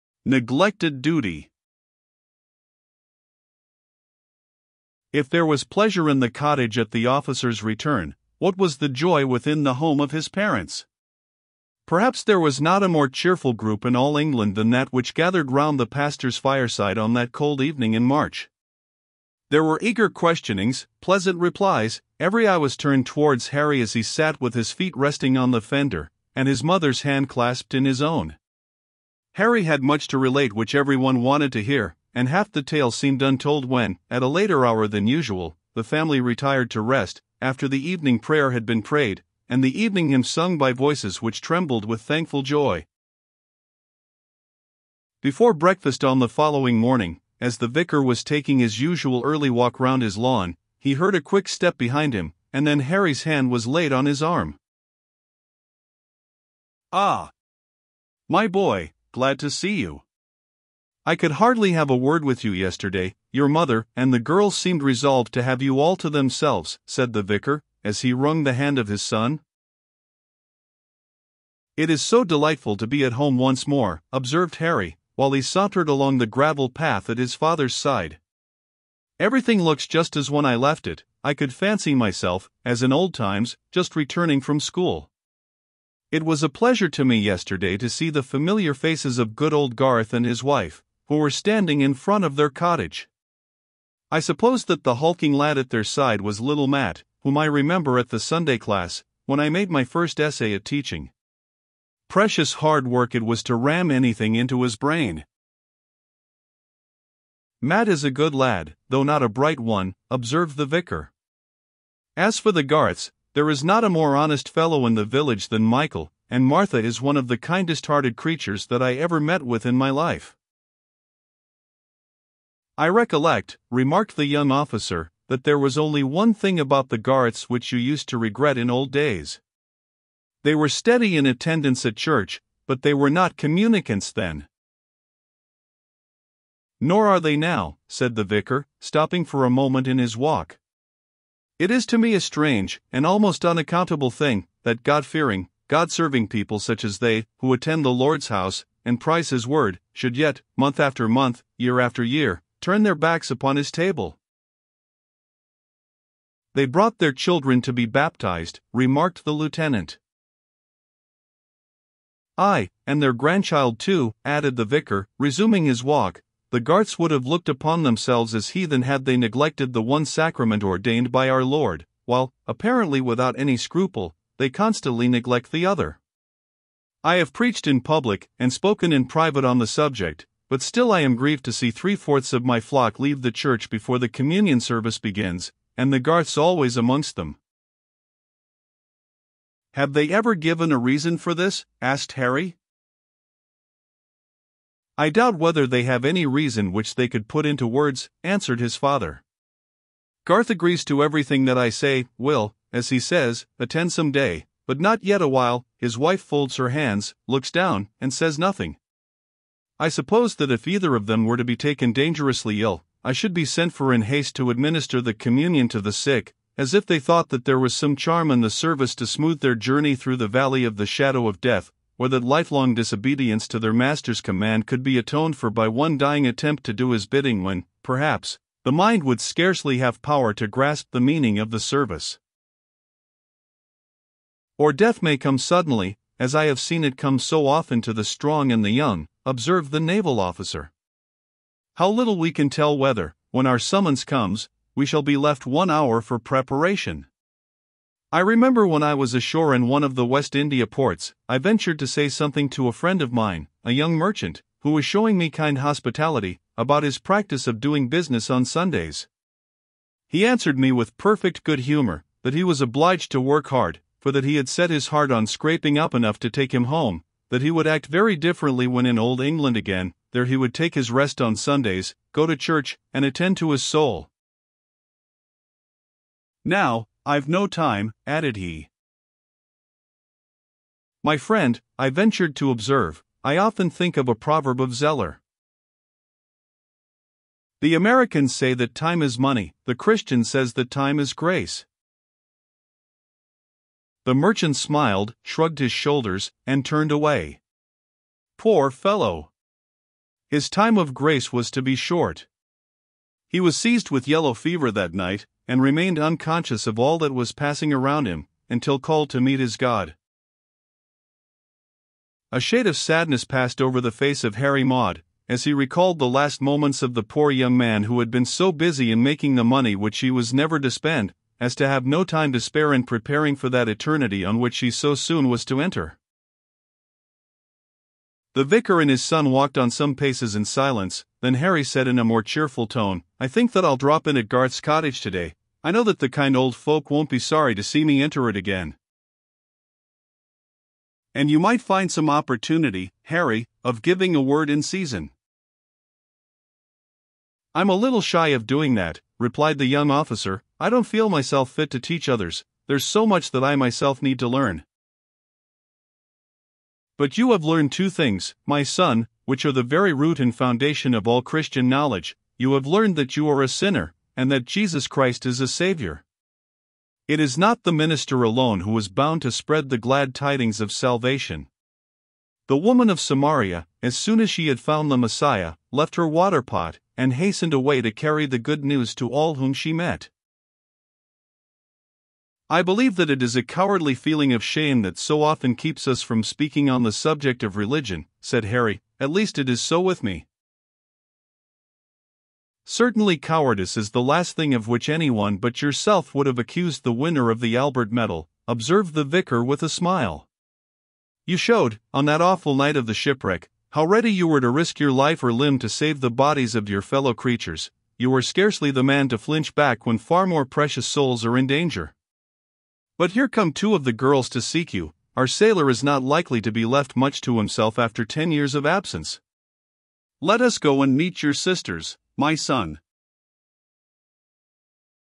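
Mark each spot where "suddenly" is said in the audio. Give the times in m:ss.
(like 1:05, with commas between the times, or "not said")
3:55.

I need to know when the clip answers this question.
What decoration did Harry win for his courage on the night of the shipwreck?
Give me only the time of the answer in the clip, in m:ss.
6:37.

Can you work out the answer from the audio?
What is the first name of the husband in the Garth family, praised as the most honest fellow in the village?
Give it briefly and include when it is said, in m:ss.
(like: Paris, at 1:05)
Michael, at 1:55.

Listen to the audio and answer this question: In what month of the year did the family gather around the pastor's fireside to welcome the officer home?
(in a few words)
March.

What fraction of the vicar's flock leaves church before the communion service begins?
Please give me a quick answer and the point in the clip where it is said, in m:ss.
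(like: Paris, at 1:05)
three fourths, at 3:01.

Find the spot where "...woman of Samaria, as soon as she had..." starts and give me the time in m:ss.
6:12.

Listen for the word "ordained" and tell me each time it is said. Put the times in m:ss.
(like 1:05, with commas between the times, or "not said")
2:50.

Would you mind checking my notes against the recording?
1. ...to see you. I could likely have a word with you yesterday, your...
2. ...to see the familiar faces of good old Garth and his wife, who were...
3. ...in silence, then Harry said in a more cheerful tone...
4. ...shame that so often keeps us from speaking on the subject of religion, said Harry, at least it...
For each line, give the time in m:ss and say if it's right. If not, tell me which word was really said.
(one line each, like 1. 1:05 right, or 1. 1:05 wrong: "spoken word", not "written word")
1. 0:59 wrong: "hardly", not "likely"
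2. 1:27 right
3. 5:30 right
4. 6:24 right.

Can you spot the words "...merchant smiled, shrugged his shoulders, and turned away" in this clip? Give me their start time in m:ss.
4:54.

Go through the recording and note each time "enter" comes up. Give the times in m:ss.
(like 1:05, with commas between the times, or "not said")
5:25, 5:38.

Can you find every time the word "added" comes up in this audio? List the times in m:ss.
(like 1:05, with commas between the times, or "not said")
2:44, 4:38.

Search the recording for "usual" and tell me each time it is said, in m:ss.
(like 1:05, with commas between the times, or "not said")
0:35, 0:48.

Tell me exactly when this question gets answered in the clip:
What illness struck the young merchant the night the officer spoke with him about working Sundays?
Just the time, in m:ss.
5:04.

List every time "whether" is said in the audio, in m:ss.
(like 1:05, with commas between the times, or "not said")
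3:15, 4:02.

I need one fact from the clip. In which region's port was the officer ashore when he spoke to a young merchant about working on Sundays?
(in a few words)
West India.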